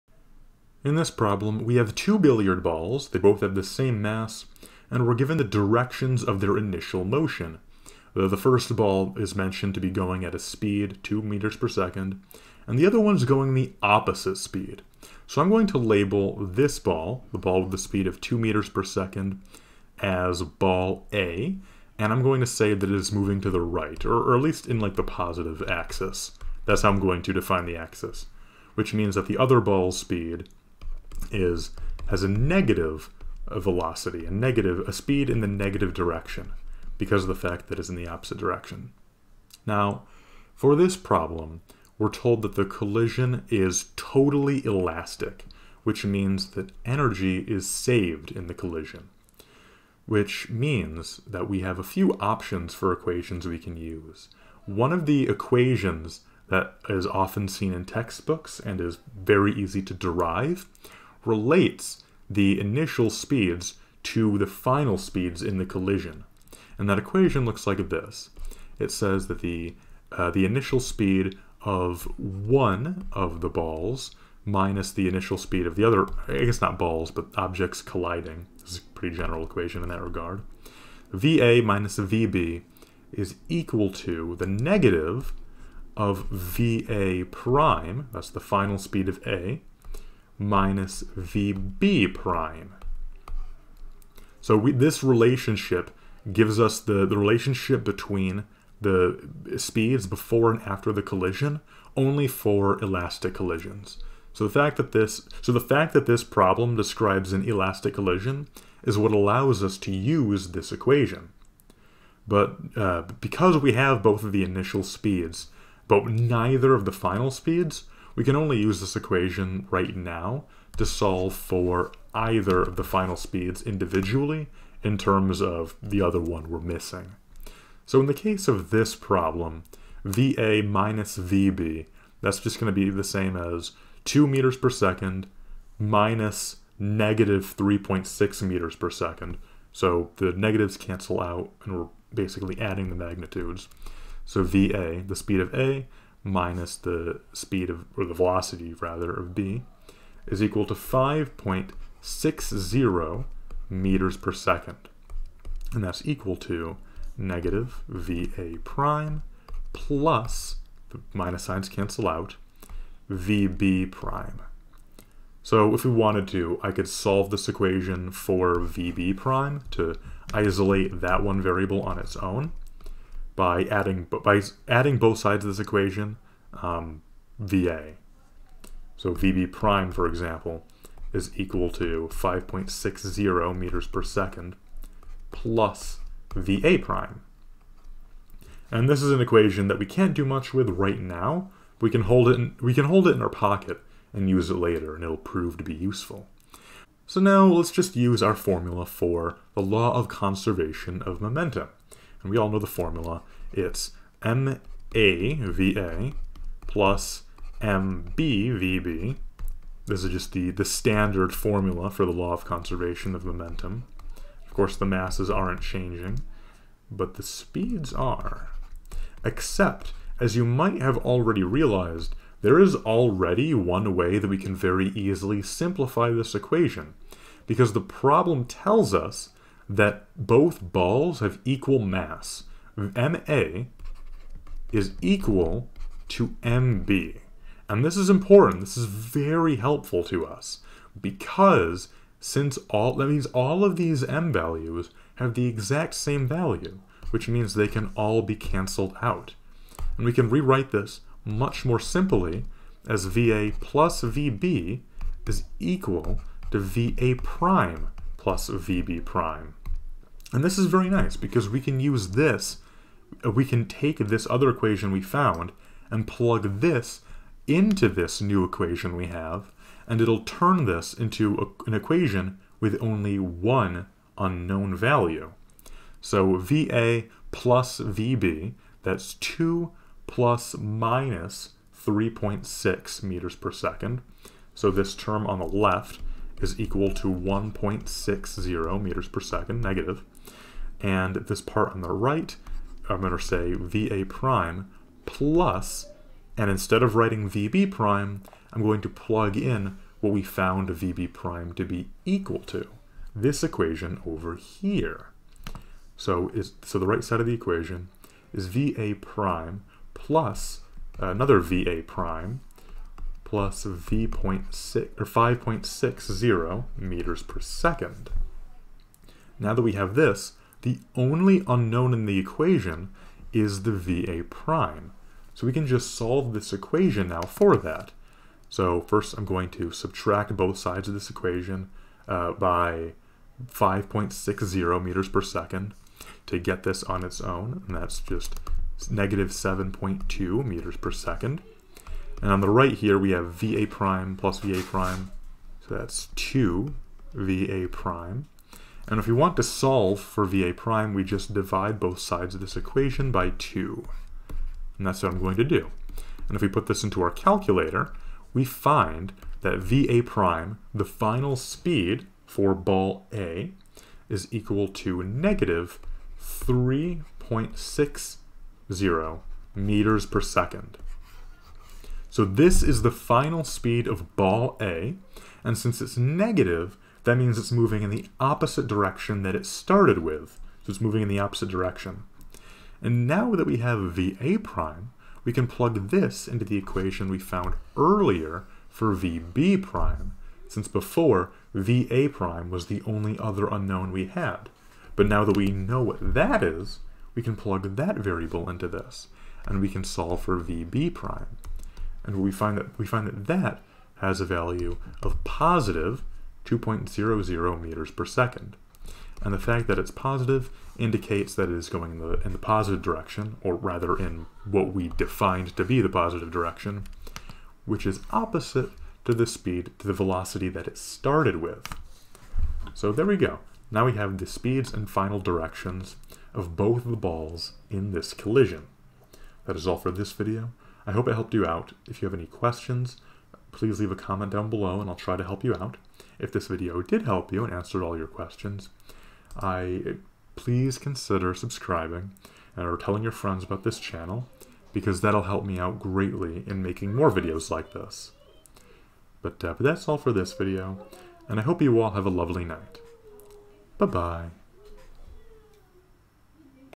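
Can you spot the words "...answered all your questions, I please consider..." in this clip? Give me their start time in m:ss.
7:17.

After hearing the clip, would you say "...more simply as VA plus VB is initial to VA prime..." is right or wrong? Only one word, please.
wrong.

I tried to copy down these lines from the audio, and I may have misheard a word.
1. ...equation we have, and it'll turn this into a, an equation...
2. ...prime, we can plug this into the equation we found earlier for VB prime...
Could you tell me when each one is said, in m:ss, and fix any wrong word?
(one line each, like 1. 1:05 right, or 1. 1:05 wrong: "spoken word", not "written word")
1. 4:28 right
2. 6:24 right.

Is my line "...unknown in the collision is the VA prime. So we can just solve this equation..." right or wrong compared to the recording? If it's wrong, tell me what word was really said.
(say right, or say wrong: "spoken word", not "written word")
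wrong: "equation", not "collision".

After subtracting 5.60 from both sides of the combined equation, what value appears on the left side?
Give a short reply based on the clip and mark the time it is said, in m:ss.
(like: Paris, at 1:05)
-7.2 m/s, at 5:38.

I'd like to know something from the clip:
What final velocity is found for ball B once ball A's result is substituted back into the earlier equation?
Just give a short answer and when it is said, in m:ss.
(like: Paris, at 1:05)
2.00 m/s, at 6:45.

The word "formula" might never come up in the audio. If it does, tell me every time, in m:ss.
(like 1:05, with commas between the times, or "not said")
3:18, 3:22, 3:31.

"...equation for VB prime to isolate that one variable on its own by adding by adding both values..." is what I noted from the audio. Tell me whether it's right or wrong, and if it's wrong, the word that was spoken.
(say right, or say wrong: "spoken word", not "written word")
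wrong: "sides", not "values".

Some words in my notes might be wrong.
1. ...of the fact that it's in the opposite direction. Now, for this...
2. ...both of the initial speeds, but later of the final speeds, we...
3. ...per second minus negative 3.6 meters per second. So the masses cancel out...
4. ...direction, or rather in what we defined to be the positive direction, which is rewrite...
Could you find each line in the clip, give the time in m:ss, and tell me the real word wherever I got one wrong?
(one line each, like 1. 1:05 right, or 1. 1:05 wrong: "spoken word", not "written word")
1. 0:37 right
2. 1:54 wrong: "neither", not "later"
3. 2:14 wrong: "negatives", not "masses"
4. 6:52 wrong: "opposite", not "rewrite".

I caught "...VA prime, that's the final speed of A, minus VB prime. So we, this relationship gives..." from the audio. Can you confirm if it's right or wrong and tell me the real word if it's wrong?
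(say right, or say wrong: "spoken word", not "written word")
right.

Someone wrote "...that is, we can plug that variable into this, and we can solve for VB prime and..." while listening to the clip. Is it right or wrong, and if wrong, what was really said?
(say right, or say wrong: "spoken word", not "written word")
right.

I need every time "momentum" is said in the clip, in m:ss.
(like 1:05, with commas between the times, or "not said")
3:21, 3:33.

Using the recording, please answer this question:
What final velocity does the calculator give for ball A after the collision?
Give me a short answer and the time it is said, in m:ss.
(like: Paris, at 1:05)
-3.60 m/s, at 6:05.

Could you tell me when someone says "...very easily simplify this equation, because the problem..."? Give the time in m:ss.
3:44.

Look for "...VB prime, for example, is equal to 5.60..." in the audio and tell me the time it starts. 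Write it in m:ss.
2:59.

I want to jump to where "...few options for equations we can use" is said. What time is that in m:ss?
0:51.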